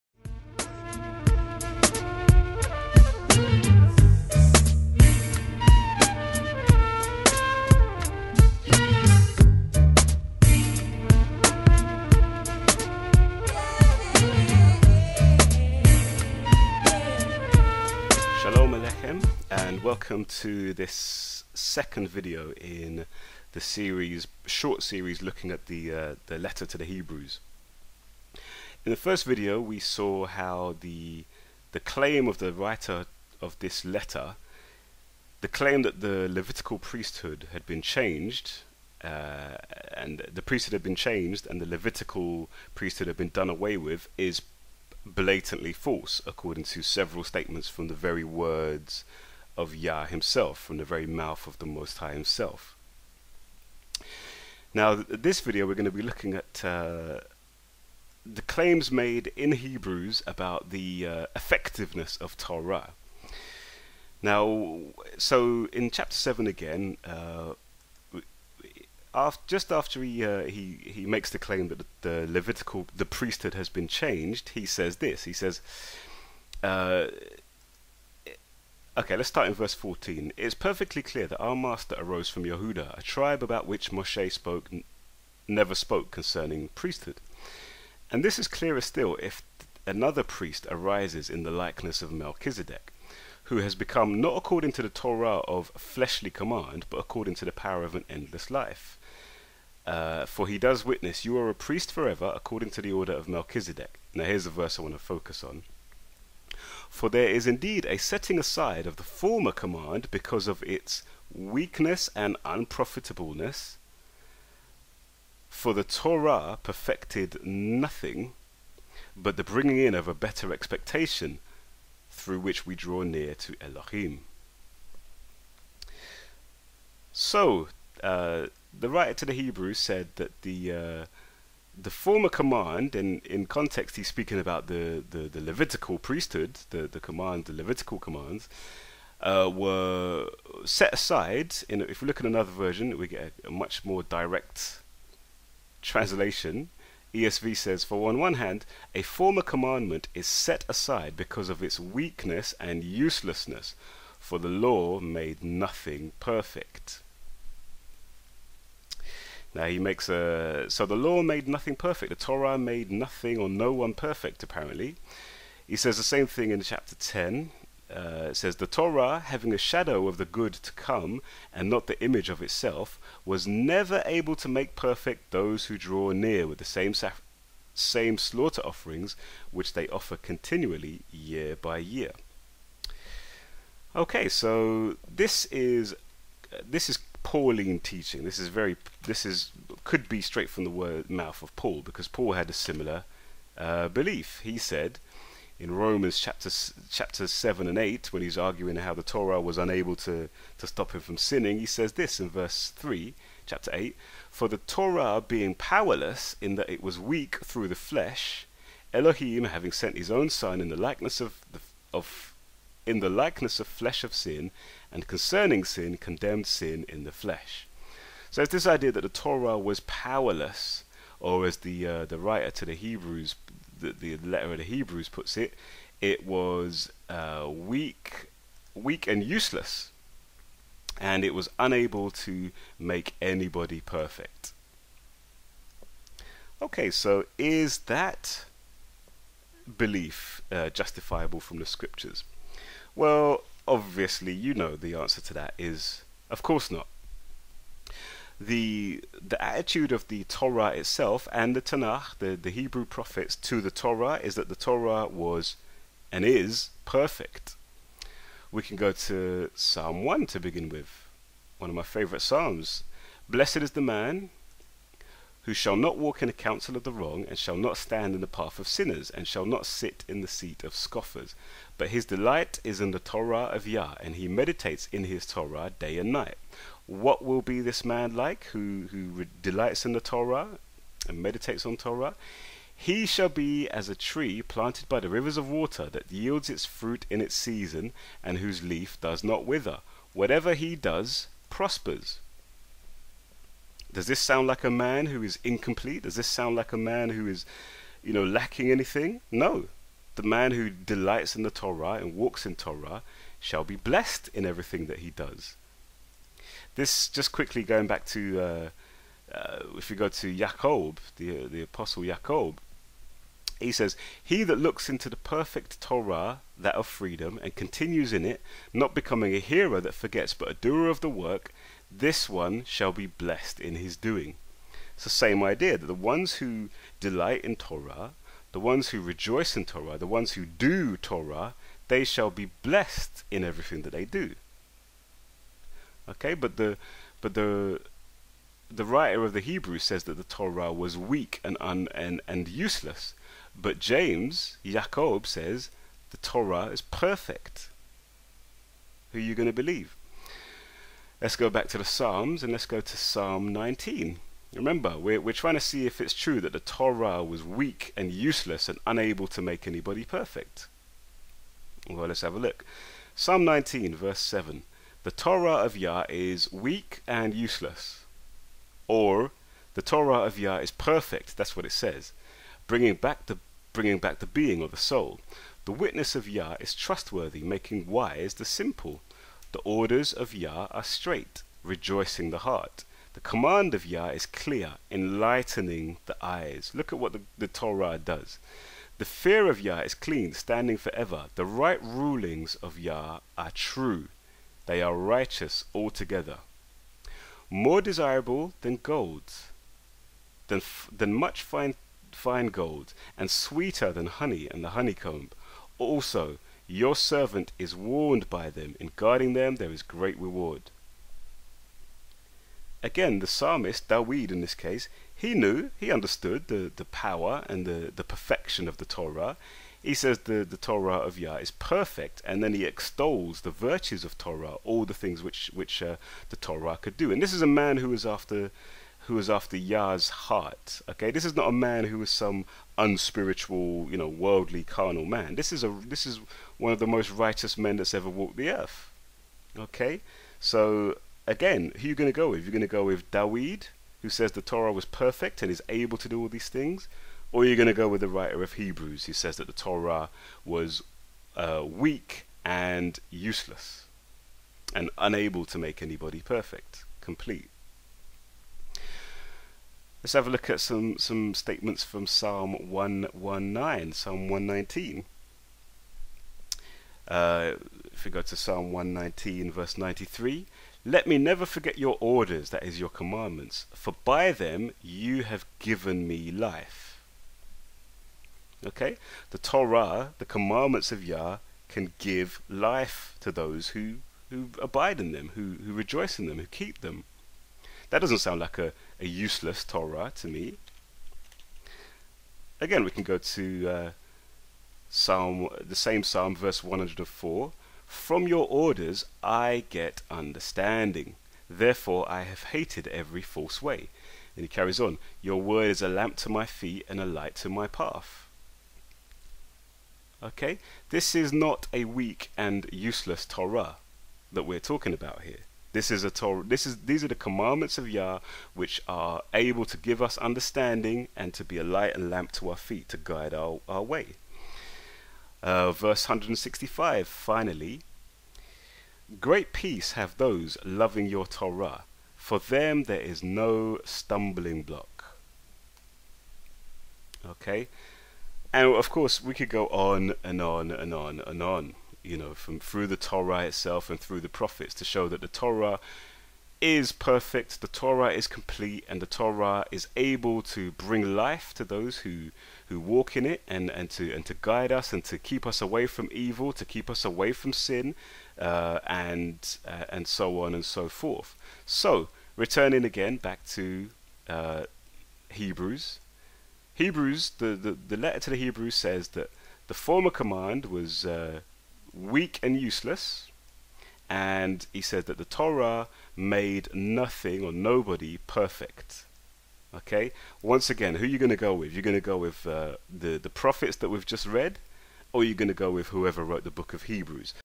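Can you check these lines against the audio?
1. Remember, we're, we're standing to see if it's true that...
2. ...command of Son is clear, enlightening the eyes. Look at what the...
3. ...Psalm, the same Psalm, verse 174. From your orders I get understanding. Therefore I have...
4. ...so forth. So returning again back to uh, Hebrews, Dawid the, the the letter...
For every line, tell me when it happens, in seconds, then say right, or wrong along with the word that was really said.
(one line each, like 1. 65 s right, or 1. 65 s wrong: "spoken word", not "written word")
1. 354 s wrong: "trying", not "standing"
2. 383 s wrong: "Yah", not "Son"
3. 494 s wrong: "104", not "174"
4. 560 s wrong: "Hebrews", not "Dawid".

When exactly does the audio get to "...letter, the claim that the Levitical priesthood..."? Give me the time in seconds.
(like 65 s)
33 s.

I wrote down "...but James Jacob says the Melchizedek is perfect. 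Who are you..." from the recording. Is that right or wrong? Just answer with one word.
wrong.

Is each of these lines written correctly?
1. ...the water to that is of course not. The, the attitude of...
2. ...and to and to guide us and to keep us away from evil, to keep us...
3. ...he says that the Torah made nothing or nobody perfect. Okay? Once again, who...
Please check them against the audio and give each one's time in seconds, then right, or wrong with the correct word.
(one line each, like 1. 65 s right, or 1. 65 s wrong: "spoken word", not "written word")
1. 244 s wrong: "answer", not "water"
2. 553 s right
3. 574 s right.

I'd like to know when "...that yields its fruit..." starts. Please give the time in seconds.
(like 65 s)
285 s.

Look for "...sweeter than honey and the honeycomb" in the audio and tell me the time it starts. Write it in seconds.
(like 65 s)
403 s.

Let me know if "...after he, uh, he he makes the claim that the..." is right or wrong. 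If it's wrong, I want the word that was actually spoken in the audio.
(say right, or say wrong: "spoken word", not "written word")
right.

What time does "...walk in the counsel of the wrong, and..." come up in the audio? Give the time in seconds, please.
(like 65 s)
265 s.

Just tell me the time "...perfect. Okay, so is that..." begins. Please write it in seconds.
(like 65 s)
233 s.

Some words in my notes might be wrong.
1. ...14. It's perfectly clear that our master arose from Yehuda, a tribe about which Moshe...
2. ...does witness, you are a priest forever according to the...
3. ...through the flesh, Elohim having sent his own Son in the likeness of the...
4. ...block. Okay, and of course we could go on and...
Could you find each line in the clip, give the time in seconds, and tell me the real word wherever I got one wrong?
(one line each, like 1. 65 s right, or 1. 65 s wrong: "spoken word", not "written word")
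1. 79 s right
2. 100 s right
3. 207 s right
4. 534 s right.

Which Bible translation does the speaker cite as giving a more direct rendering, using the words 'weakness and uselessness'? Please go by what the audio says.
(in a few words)
ESV.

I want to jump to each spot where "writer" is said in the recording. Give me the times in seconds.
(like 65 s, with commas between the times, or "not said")
32 s, 128 s, 222 s, 338 s, 448 s.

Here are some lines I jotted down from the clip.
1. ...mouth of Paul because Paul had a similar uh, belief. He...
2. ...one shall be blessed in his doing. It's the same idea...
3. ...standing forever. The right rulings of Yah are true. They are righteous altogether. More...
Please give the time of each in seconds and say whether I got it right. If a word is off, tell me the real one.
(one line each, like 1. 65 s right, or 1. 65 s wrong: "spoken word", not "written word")
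1. 191 s right
2. 322 s right
3. 390 s right.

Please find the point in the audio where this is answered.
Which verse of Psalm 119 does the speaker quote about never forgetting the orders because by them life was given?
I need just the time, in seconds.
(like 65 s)
469 s.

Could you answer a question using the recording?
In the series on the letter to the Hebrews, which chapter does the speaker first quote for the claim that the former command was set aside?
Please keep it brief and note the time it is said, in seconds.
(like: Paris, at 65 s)
chapter 7, at 65 s.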